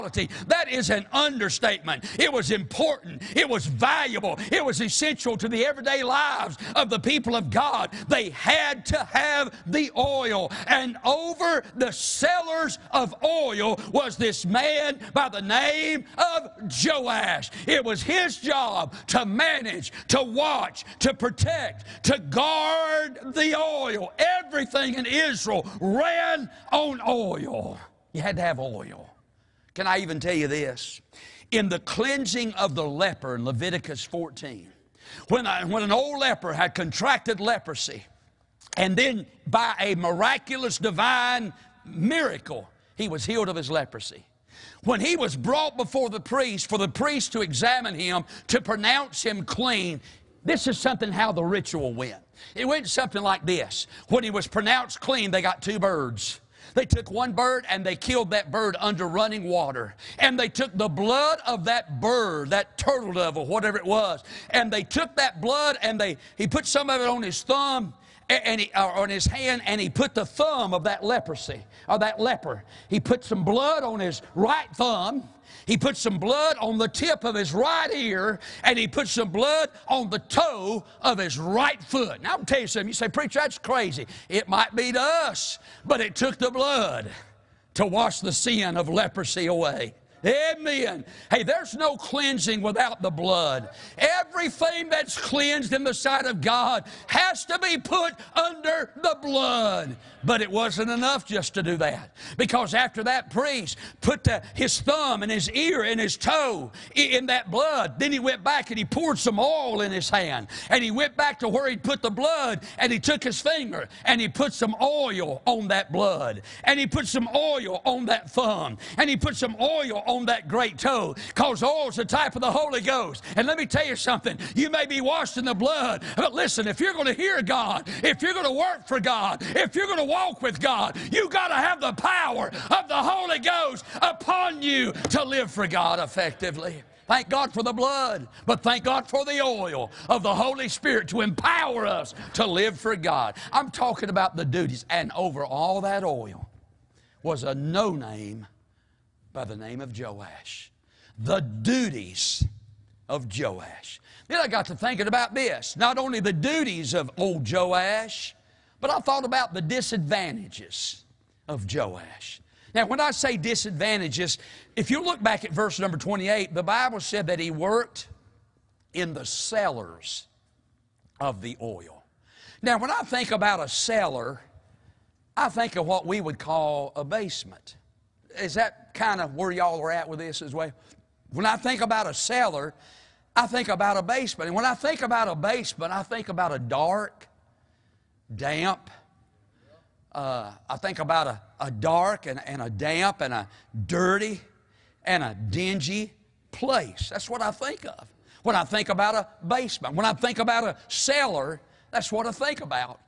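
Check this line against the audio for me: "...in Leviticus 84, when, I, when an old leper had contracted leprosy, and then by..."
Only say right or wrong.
wrong.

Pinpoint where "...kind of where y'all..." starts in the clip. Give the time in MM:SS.
02:58.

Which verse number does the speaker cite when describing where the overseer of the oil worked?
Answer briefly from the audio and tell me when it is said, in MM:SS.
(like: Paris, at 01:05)
28, at 02:45.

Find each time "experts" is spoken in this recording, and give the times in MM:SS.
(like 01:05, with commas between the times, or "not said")
not said.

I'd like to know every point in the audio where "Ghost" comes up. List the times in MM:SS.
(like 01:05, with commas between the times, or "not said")
02:02, 02:13.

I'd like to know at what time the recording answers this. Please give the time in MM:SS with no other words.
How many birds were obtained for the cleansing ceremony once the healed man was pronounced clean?
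00:55.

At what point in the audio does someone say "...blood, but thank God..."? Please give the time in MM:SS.
02:17.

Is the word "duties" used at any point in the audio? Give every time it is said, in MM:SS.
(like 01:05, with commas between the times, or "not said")
02:24, 02:31, 02:36.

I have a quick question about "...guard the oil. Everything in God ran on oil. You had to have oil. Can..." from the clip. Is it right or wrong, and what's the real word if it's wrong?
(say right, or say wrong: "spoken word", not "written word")
wrong: "Israel", not "God".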